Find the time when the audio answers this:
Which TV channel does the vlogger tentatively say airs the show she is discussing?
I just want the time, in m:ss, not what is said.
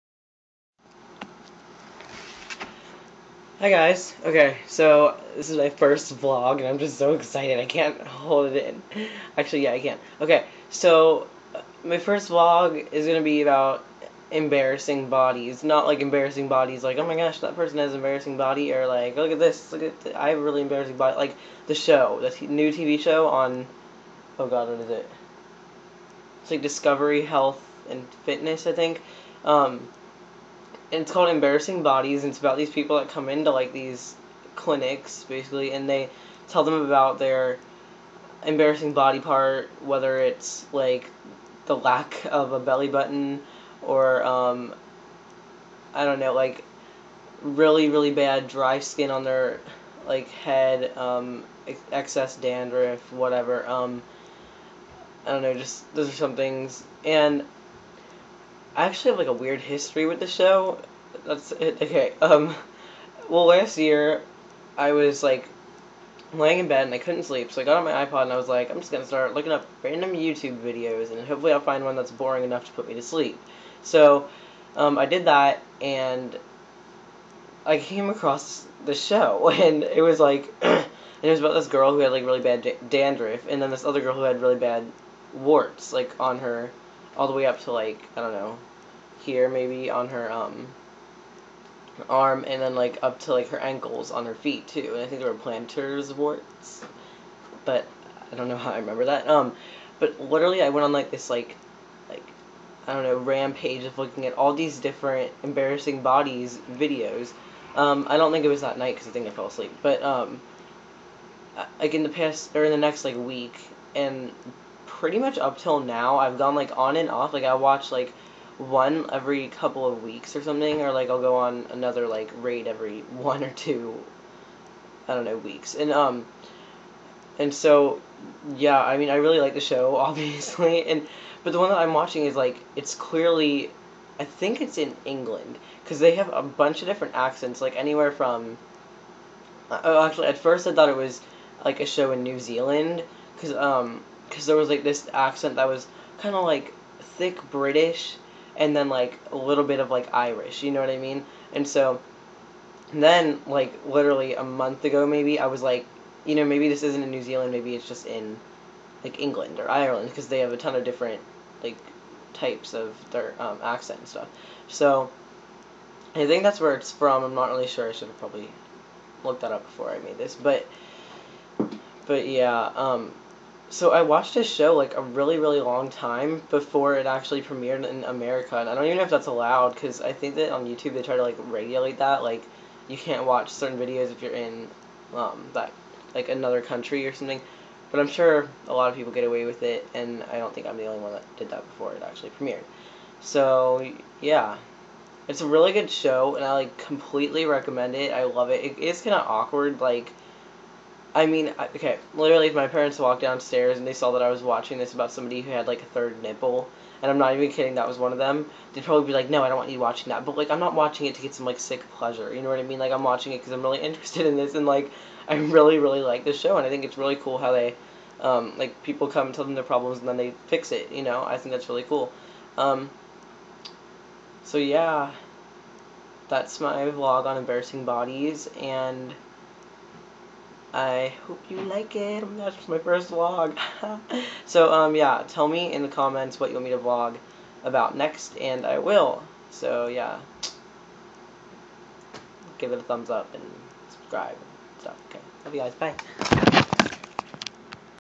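0:26.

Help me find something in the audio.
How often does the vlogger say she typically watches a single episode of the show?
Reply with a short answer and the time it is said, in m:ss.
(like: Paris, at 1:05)
every couple of weeks, at 1:59.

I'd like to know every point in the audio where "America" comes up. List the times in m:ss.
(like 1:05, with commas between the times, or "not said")
2:58.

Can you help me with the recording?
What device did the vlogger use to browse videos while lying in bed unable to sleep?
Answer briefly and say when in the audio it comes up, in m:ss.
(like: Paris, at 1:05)
iPod, at 1:08.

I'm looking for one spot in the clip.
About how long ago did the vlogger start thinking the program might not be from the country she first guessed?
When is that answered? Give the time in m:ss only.
2:34.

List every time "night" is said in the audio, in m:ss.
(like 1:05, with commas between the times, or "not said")
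1:48.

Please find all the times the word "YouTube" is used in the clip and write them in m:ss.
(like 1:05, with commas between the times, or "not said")
1:10, 3:00.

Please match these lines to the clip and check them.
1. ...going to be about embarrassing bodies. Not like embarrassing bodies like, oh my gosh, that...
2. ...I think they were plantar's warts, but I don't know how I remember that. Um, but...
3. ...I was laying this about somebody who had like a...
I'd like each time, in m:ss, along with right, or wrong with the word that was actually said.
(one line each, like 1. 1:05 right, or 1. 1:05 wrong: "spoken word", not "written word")
1. 0:13 right
2. 1:35 right
3. 3:24 wrong: "watching", not "laying".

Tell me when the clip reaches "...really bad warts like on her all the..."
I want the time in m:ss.
1:24.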